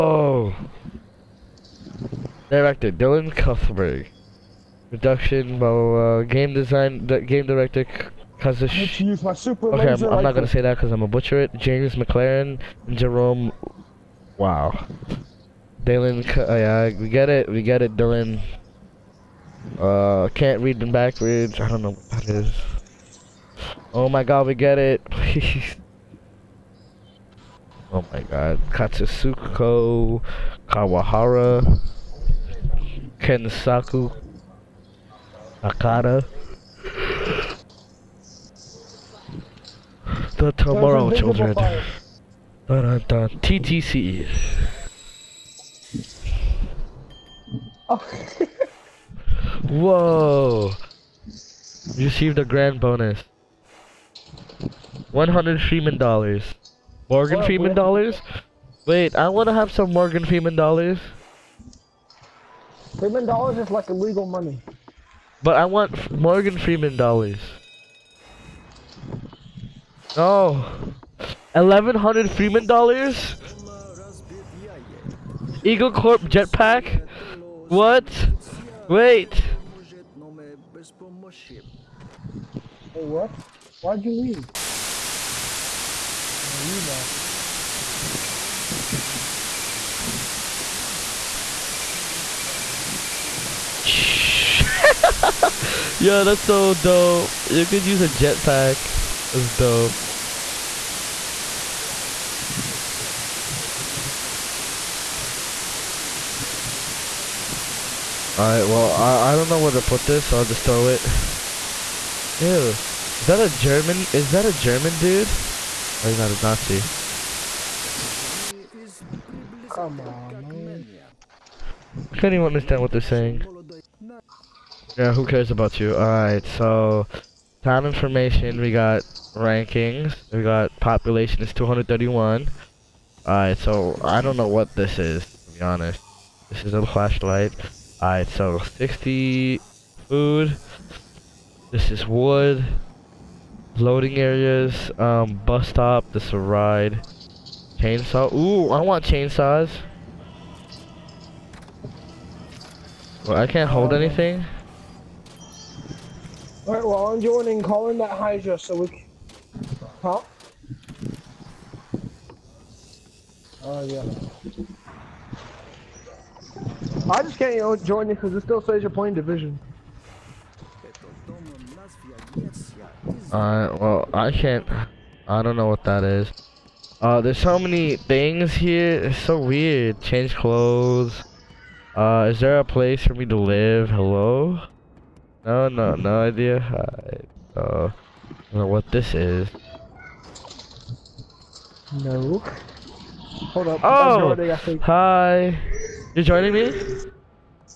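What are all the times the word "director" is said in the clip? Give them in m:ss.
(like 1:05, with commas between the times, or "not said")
0:02, 0:07.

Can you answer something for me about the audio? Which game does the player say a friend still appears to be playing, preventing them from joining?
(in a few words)
Division.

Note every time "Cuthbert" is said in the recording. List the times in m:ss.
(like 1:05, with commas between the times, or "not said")
0:03.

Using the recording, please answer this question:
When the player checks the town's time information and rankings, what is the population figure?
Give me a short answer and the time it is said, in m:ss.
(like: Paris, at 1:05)
231, at 2:11.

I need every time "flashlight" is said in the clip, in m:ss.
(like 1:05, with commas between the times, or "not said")
2:16.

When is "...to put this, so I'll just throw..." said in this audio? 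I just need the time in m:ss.
1:49.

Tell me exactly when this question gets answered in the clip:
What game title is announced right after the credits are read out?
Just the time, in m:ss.
0:40.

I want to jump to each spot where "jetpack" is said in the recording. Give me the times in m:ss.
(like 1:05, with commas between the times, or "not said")
1:16, 1:38.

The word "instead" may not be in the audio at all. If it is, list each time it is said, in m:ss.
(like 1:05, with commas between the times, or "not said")
not said.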